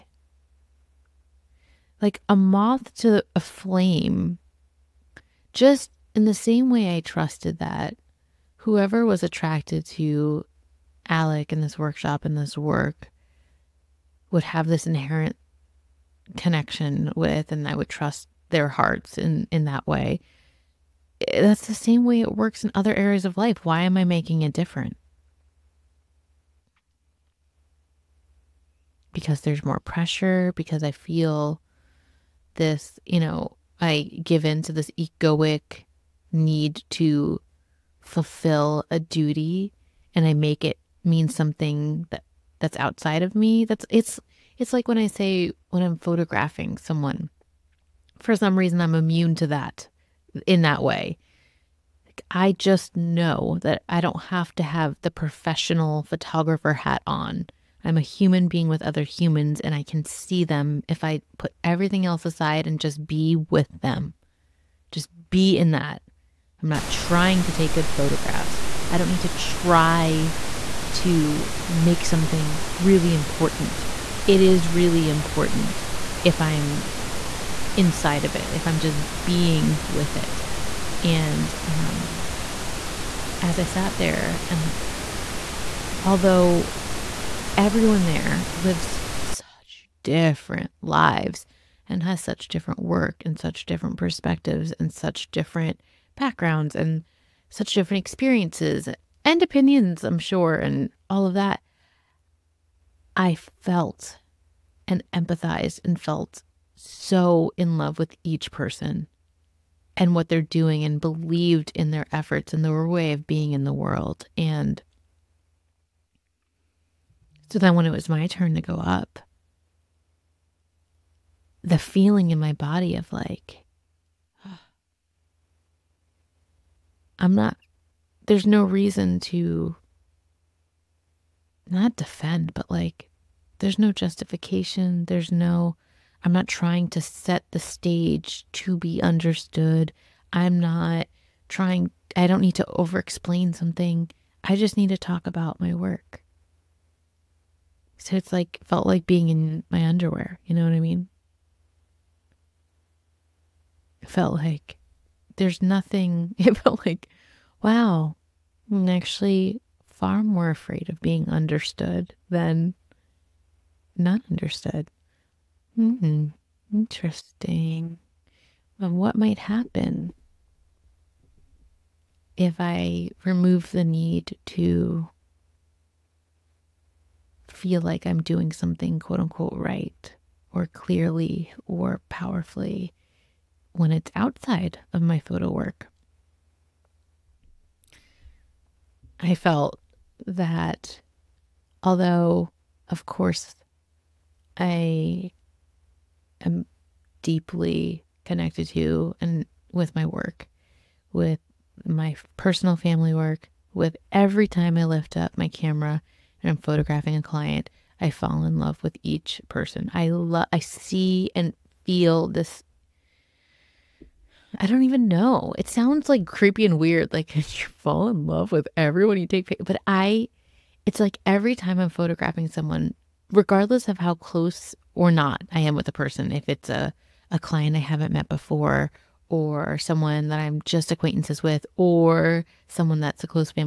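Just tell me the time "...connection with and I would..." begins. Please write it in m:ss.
0:16.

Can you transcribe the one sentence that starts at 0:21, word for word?
That's the same way it works in other areas of life.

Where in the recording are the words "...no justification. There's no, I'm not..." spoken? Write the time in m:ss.
2:13.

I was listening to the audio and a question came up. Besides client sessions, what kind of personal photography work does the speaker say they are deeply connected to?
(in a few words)
personal family work.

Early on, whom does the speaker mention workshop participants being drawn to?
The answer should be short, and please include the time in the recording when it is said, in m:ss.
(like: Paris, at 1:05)
Alec, at 0:11.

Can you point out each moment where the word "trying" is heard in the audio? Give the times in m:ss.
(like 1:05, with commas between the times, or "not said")
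1:06, 2:16, 2:21.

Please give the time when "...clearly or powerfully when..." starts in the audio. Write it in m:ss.
3:00.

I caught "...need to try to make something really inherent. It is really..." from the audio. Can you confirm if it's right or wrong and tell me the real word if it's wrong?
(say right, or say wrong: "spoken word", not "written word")
wrong: "important", not "inherent".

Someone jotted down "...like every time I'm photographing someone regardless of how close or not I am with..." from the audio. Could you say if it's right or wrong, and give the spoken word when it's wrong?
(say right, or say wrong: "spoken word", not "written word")
right.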